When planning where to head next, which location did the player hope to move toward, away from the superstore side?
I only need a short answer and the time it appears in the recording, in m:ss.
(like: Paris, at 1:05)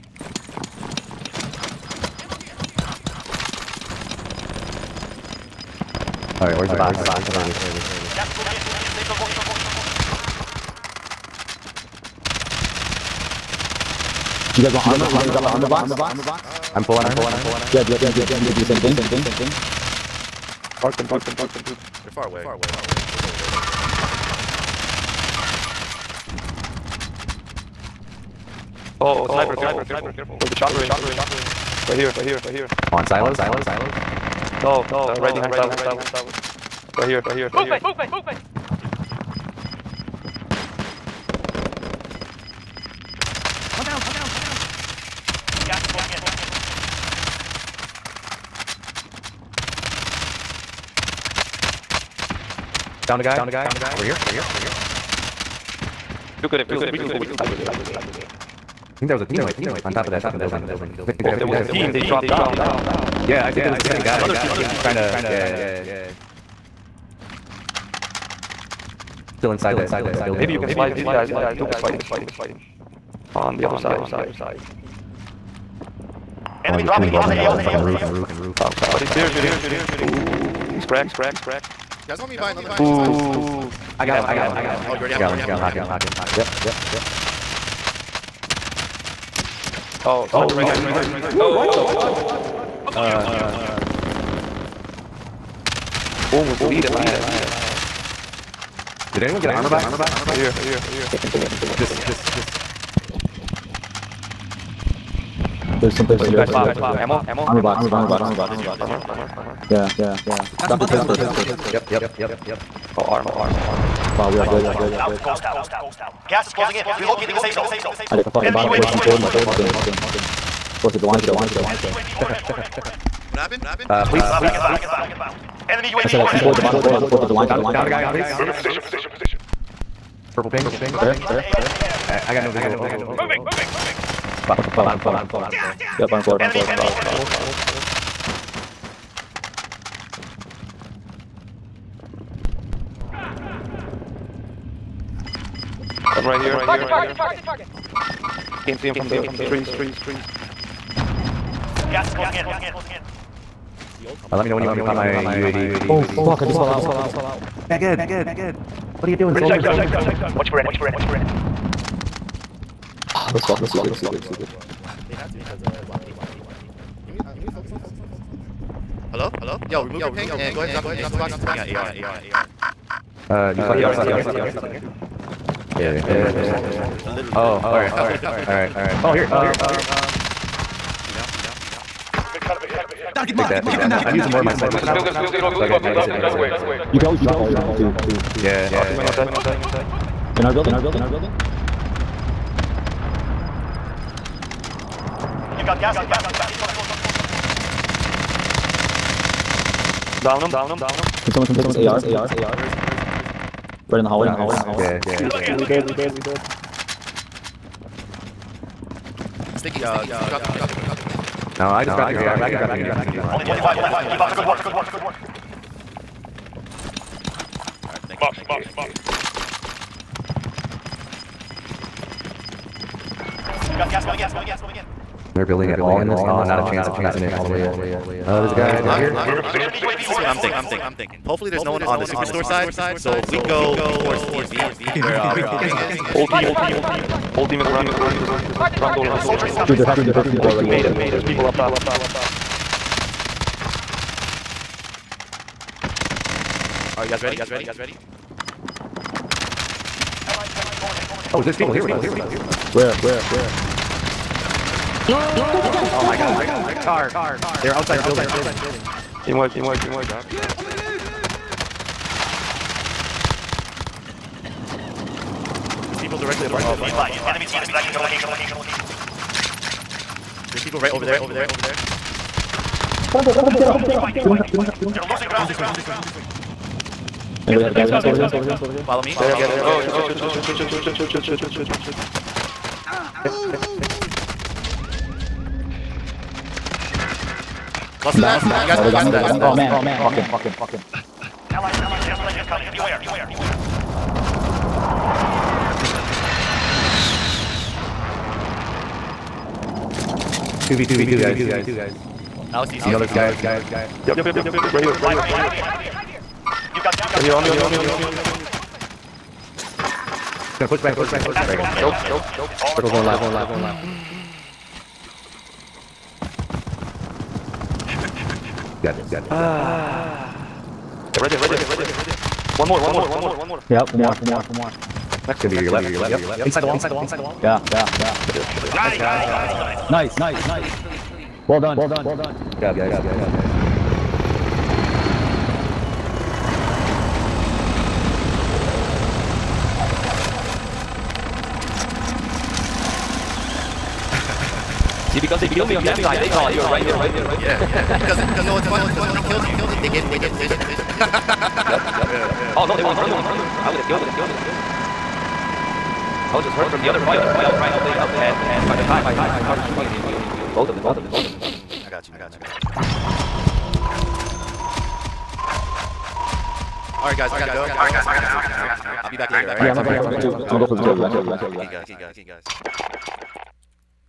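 The DMV, at 3:54.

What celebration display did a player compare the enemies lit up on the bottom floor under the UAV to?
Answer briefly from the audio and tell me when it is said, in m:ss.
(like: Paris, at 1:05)
Fourth of July show, at 2:00.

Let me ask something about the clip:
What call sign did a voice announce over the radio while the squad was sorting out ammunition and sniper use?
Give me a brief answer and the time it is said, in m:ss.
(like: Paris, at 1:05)
Builder 2-0, at 3:05.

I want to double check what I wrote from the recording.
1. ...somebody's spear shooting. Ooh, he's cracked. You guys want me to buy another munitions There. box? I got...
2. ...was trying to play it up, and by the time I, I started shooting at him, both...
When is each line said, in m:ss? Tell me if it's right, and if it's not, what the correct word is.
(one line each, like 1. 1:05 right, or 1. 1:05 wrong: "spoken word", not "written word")
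1. 1:18 wrong: "Ooh", not "There"
2. 5:57 right.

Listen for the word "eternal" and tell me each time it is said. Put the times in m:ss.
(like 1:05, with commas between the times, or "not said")
not said.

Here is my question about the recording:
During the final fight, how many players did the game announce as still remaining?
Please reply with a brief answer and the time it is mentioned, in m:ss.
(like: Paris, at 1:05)
5, at 5:04.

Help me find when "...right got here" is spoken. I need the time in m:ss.
1:30.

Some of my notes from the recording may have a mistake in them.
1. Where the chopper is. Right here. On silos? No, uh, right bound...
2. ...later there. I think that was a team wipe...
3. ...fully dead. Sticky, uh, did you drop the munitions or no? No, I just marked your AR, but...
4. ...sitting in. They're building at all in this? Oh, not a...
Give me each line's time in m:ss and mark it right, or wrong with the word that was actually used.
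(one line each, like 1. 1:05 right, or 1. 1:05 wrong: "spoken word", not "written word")
1. 0:30 wrong: "behind", not "bound"
2. 0:57 wrong: "sniper", not "later"
3. 3:25 wrong: "dropped", not "marked"
4. 3:44 wrong: "moving", not "sitting".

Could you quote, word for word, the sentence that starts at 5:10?
He's gonna push back towards you, gas Dragon.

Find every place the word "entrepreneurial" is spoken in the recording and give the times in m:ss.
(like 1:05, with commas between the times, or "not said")
not said.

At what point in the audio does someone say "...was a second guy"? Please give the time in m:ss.
1:03.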